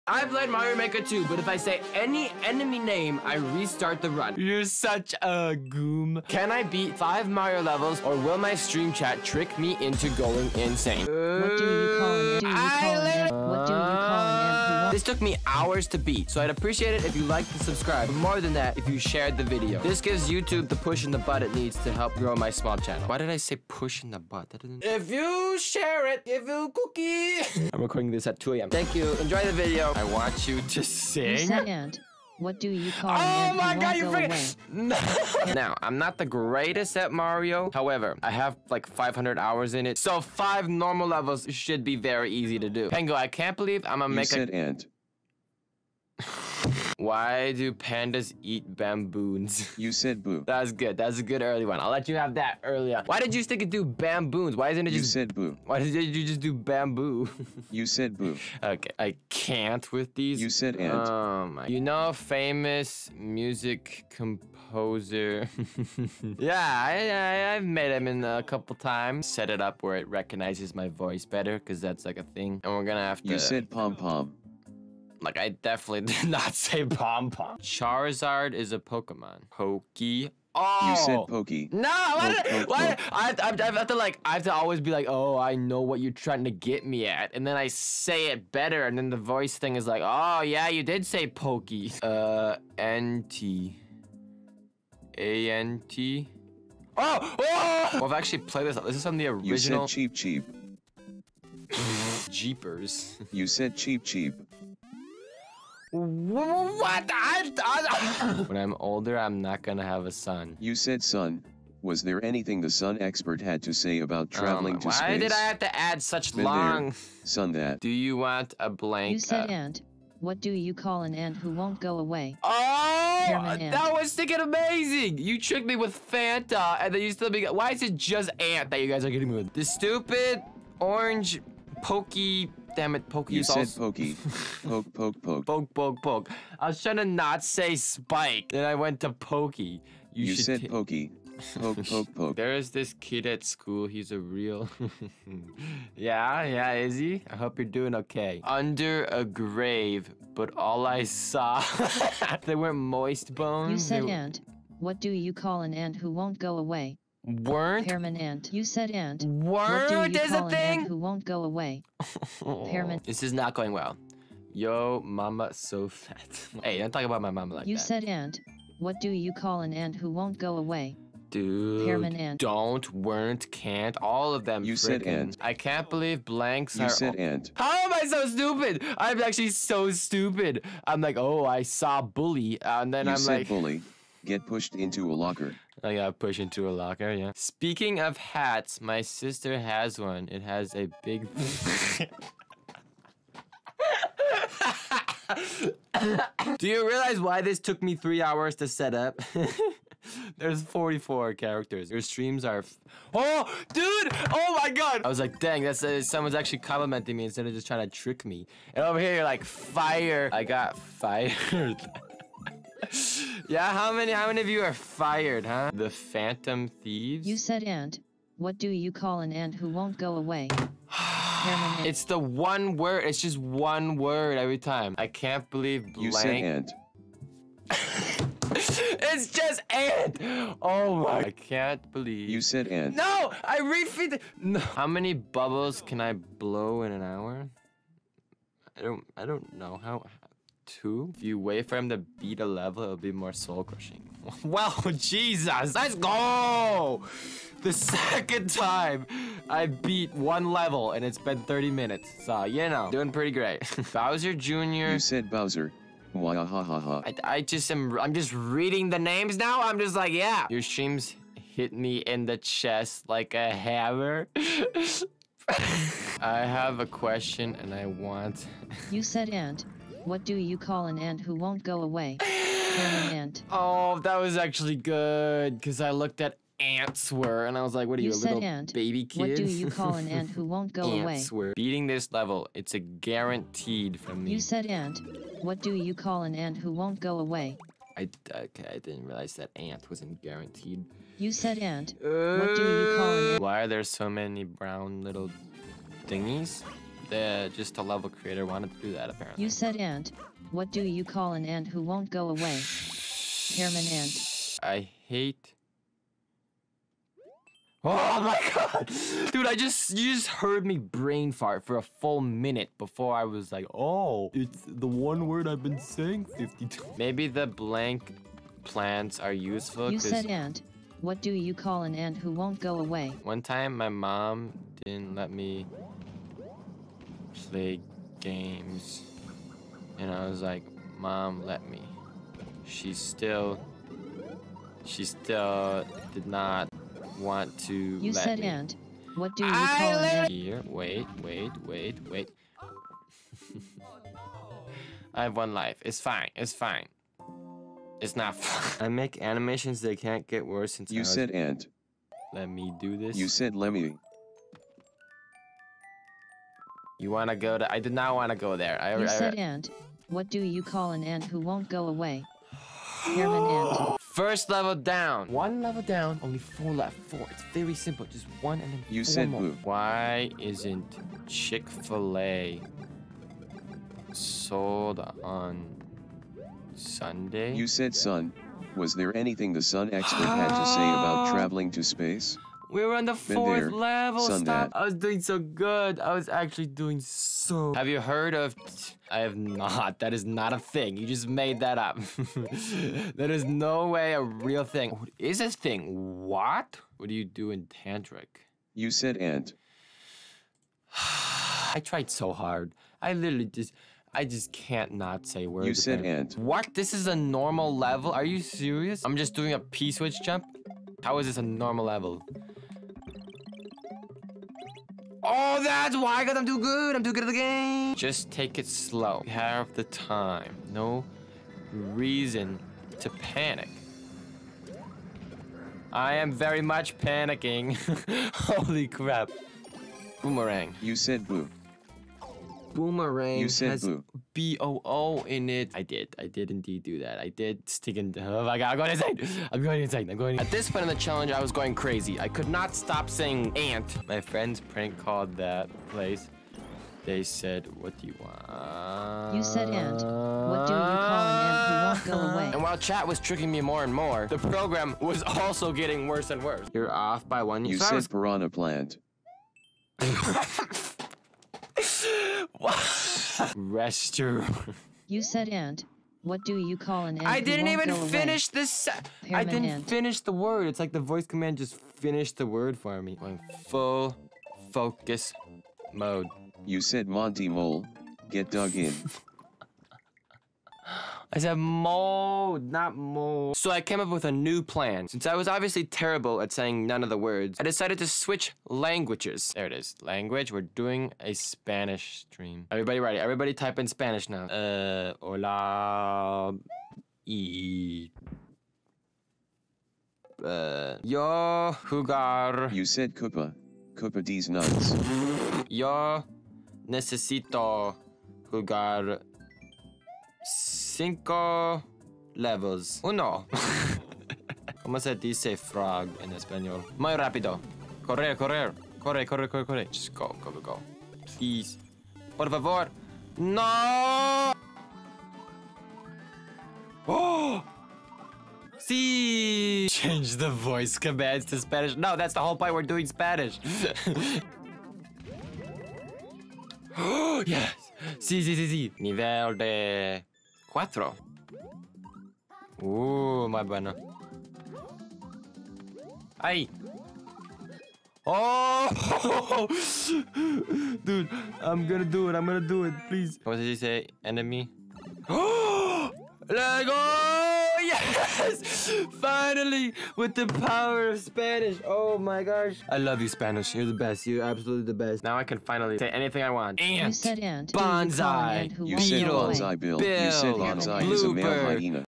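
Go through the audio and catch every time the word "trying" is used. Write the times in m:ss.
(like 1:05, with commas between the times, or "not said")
1:26, 2:16, 3:27.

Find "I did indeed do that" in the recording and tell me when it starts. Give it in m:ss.
7:16.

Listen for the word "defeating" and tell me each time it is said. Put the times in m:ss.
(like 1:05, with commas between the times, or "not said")
not said.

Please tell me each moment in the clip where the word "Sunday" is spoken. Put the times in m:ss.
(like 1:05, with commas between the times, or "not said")
6:16.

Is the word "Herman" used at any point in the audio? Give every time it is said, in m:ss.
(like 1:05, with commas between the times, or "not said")
5:03, 6:03.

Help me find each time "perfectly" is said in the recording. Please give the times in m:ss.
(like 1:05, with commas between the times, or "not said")
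not said.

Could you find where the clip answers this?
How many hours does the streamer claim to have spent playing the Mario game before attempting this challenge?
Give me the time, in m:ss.
0:38.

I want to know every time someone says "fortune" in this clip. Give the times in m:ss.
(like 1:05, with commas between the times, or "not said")
not said.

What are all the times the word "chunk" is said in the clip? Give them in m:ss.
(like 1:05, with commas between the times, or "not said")
not said.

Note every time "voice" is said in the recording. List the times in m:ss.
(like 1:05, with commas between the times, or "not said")
1:10, 1:29, 7:50, 8:50.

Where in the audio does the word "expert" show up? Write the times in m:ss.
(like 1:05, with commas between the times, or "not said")
1:53, 6:19.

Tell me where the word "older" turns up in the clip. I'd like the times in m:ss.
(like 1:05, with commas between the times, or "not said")
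1:48.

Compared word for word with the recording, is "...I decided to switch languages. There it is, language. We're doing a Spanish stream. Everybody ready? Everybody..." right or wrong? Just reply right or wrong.
right.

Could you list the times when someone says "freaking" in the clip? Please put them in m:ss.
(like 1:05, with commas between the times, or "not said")
0:34.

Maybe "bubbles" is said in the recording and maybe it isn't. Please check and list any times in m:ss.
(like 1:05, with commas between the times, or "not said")
3:55.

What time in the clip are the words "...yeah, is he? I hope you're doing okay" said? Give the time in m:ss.
2:26.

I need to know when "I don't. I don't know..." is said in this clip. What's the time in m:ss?
3:58.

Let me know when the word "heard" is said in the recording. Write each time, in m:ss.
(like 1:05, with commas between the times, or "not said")
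5:10, 6:27.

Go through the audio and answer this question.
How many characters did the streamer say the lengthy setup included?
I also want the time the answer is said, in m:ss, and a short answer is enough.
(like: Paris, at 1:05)
44, at 3:20.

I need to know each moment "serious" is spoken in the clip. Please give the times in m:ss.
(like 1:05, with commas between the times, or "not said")
6:48.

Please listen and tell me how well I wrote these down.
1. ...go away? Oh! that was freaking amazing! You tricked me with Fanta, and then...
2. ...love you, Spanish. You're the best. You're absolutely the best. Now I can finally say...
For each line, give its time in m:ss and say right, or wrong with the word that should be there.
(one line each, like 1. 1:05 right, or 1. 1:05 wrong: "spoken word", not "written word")
1. 2:01 wrong: "sticking", not "freaking"
2. 9:22 right.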